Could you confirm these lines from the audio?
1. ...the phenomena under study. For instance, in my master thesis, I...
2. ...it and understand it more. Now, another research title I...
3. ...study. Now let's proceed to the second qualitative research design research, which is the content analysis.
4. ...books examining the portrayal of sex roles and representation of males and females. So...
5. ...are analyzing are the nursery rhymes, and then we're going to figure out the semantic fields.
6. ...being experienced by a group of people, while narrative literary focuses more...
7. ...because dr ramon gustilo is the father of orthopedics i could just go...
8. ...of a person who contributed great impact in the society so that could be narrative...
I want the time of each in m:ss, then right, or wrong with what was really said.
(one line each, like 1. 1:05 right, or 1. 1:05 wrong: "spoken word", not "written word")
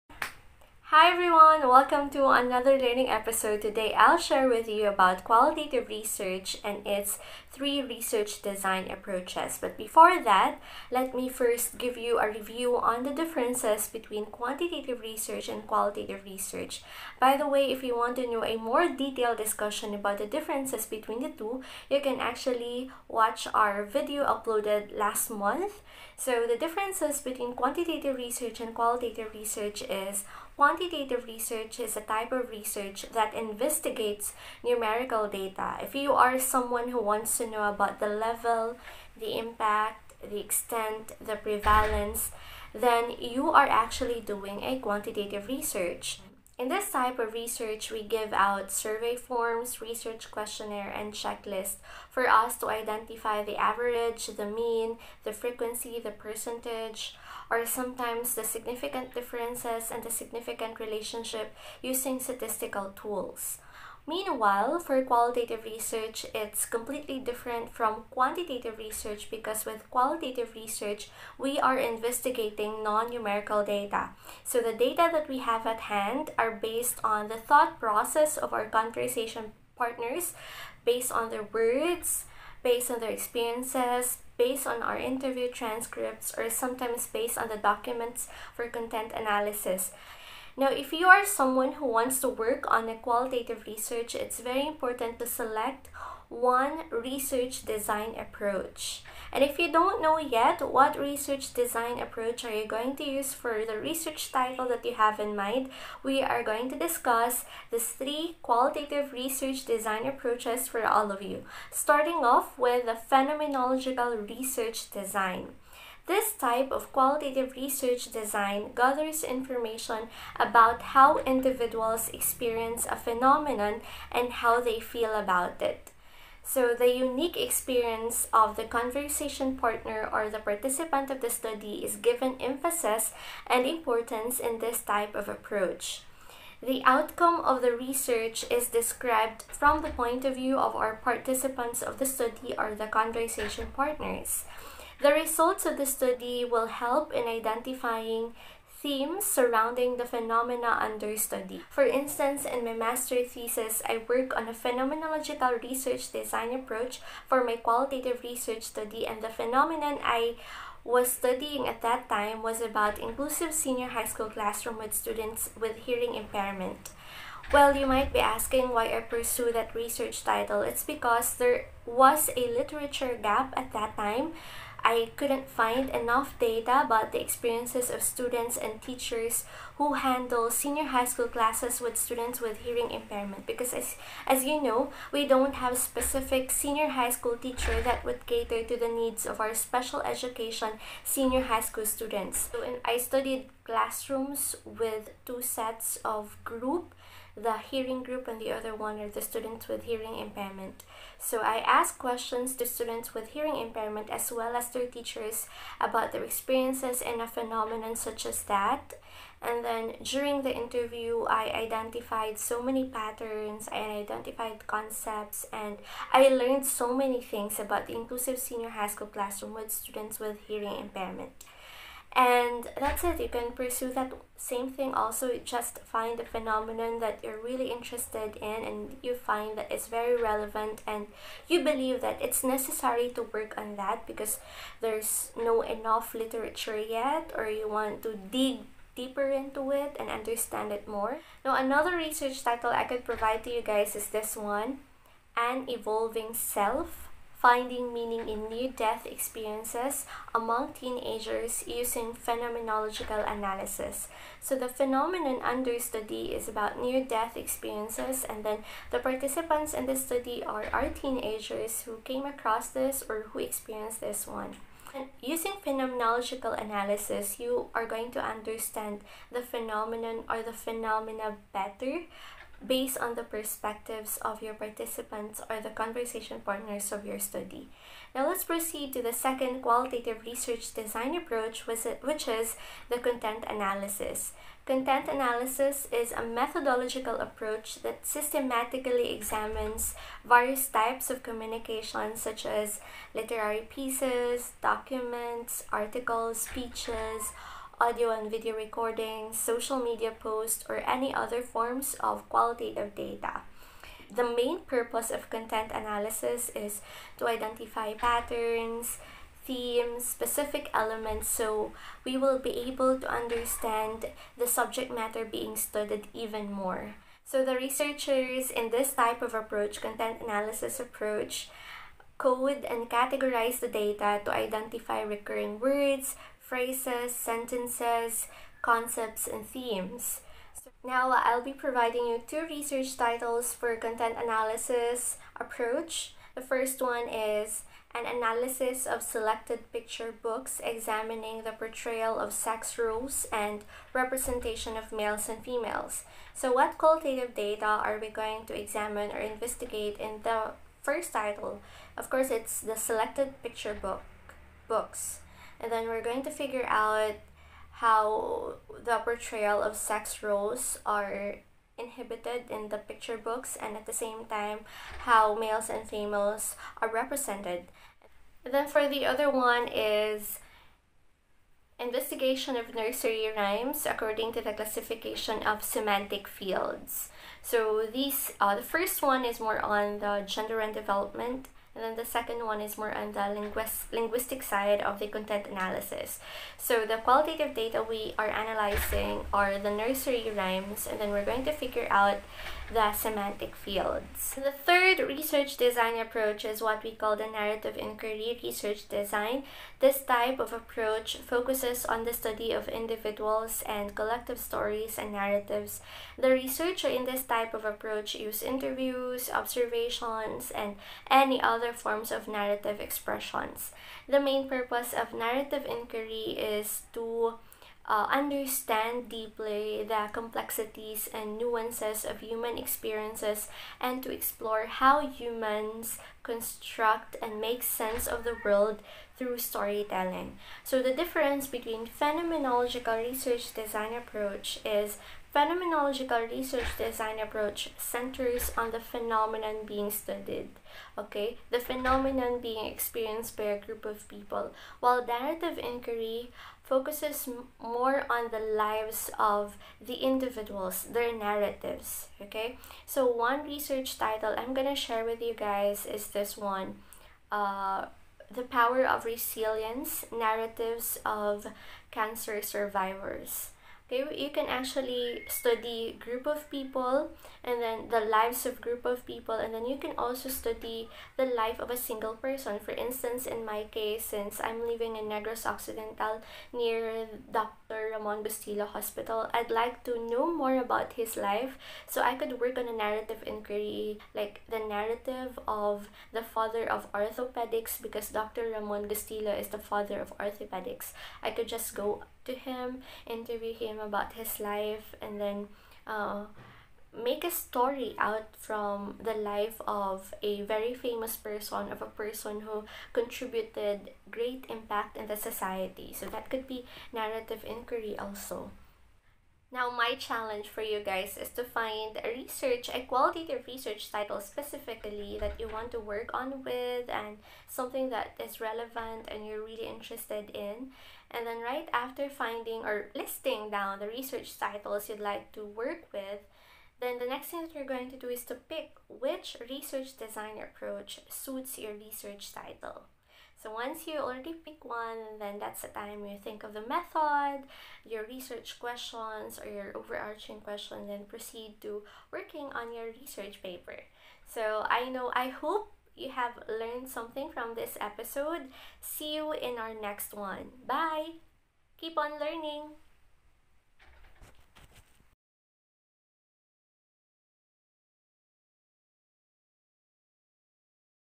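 1. 2:29 right
2. 3:59 right
3. 4:37 wrong: "approach", not "research"
4. 5:40 right
5. 6:28 right
6. 7:22 wrong: "inquiry", not "literary"
7. 8:07 right
8. 8:21 right.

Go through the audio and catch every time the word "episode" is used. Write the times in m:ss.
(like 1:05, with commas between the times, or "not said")
0:03, 9:07.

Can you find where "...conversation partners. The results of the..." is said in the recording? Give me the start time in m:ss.
2:22.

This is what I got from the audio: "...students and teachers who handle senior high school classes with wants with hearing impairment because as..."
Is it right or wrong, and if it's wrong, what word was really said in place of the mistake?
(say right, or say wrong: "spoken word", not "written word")
wrong: "students", not "wants".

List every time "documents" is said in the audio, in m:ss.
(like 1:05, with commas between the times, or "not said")
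1:27, 4:54.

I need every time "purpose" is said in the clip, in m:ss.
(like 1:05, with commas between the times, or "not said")
5:04, 6:54.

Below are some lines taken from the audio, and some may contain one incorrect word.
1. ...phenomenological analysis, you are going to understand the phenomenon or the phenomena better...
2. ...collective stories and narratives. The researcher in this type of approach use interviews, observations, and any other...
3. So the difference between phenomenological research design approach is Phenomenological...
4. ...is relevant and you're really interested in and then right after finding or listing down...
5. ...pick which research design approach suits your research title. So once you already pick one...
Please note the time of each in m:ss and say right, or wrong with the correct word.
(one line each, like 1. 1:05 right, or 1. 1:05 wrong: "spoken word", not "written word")
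1. 4:25 right
2. 6:43 right
3. 7:10 right
4. 8:38 right
5. 8:48 right.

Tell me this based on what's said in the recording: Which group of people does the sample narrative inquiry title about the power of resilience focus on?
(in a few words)
cancer survivors.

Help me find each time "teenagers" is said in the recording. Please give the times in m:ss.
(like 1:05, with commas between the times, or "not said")
4:10, 4:20.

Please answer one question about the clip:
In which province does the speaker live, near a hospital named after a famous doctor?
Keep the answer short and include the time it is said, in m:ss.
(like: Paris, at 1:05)
Negros Occidental, at 7:55.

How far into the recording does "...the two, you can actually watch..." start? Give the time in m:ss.
0:21.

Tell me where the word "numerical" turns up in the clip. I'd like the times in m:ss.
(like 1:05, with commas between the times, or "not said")
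0:34, 1:13.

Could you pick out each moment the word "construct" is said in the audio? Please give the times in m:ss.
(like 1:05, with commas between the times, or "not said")
7:06.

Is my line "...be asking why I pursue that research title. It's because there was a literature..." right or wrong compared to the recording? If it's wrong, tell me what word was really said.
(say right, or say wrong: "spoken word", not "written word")
right.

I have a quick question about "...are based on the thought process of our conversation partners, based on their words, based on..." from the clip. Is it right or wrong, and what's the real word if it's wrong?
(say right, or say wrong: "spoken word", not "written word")
right.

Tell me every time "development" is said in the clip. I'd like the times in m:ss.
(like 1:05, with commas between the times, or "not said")
6:20.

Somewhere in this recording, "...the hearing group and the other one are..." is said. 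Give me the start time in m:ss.
3:17.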